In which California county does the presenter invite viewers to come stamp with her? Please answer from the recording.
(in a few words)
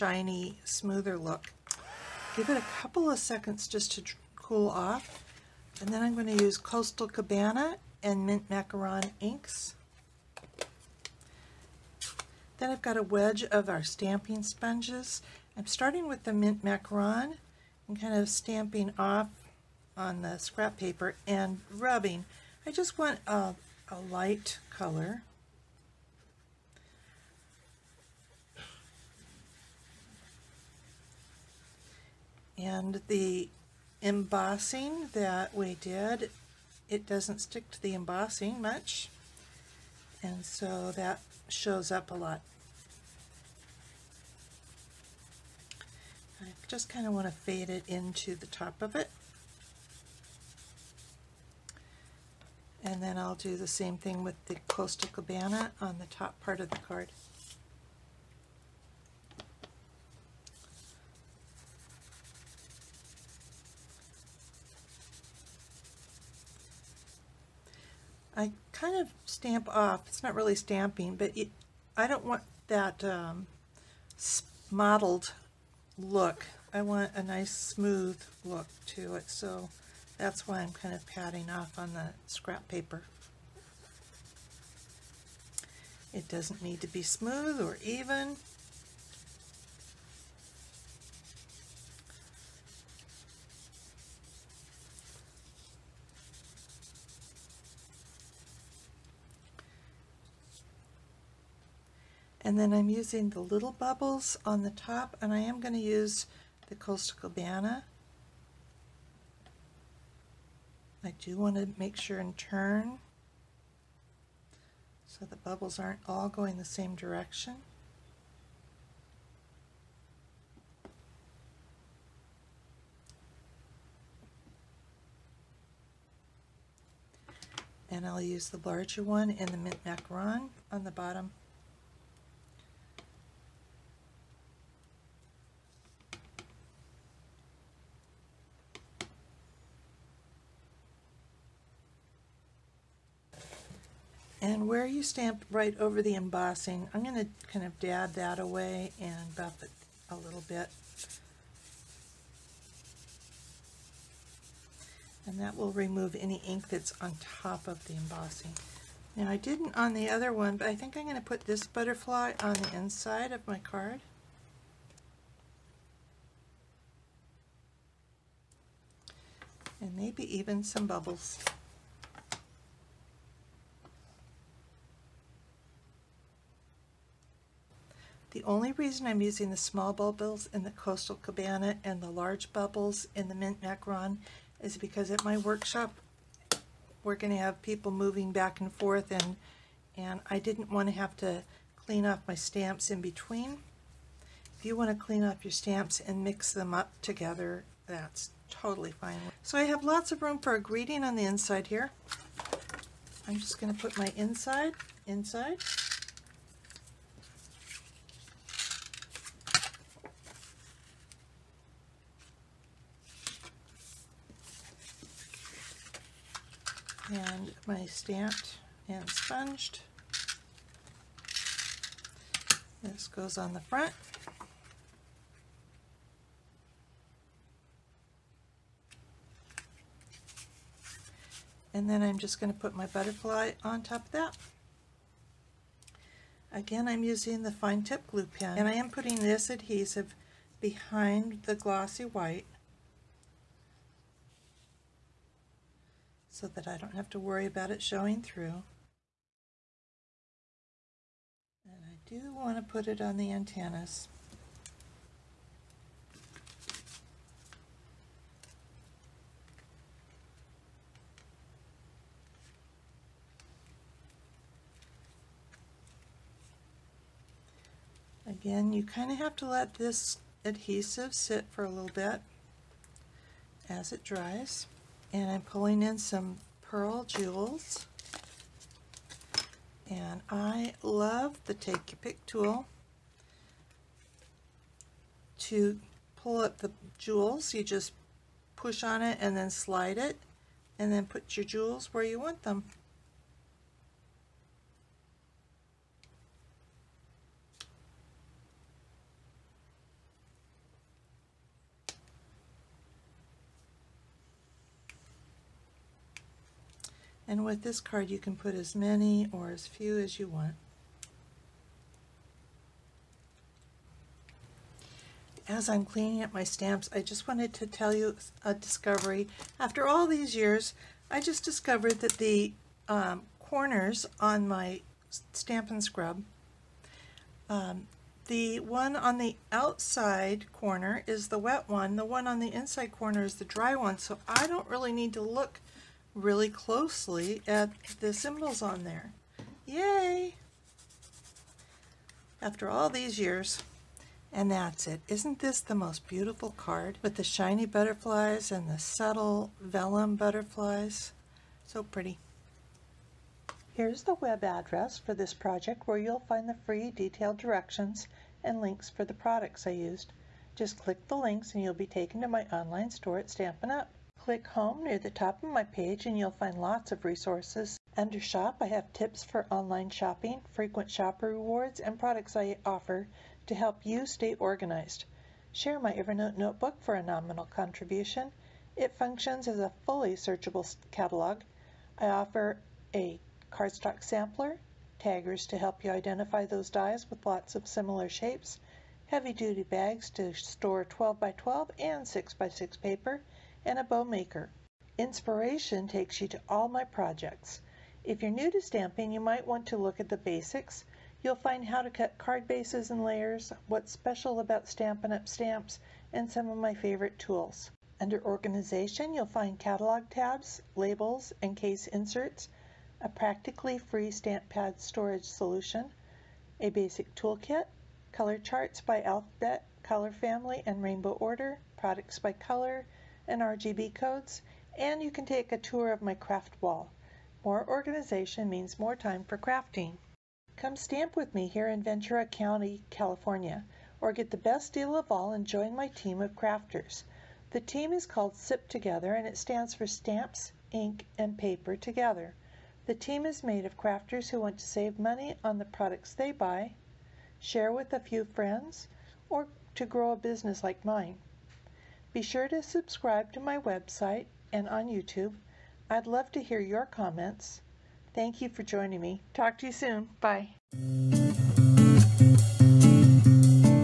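Ventura County.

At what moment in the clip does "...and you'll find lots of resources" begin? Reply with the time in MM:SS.
06:06.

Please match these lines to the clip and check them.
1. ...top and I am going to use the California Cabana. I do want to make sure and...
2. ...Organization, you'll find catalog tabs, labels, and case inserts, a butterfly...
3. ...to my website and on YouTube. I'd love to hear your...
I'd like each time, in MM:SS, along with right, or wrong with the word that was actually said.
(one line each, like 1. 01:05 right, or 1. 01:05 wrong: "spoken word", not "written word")
1. 01:44 wrong: "Coastal", not "California"
2. 06:48 wrong: "practically", not "butterfly"
3. 07:33 right.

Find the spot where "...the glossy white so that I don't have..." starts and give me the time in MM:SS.
04:01.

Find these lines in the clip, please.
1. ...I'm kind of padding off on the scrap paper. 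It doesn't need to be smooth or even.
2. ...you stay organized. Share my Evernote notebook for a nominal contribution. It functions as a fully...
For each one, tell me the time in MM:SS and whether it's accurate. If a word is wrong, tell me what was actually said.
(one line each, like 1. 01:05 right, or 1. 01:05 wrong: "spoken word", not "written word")
1. 01:20 right
2. 06:13 right.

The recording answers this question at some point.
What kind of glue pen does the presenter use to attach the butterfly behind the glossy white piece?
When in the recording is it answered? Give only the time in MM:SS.
03:57.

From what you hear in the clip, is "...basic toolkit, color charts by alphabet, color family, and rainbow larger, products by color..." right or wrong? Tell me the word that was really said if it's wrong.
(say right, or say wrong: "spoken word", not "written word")
wrong: "order", not "larger".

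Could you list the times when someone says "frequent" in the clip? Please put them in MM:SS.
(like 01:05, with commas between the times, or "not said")
06:10.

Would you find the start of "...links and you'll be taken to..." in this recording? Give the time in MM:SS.
06:01.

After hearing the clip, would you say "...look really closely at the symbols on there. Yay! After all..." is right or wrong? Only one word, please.
right.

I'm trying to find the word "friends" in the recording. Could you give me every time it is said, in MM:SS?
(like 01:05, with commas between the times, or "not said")
07:28.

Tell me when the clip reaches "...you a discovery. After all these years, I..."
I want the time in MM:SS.
05:17.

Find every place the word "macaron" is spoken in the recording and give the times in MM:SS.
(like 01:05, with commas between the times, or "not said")
00:08, 00:16, 02:09, 03:03.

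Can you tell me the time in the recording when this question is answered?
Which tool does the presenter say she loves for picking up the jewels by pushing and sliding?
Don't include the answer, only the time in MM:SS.
04:41.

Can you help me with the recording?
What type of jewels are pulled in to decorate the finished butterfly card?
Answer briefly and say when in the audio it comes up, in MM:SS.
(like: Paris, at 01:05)
pearl jewels, at 04:36.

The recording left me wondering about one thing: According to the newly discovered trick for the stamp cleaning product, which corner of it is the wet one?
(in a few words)
outside corner.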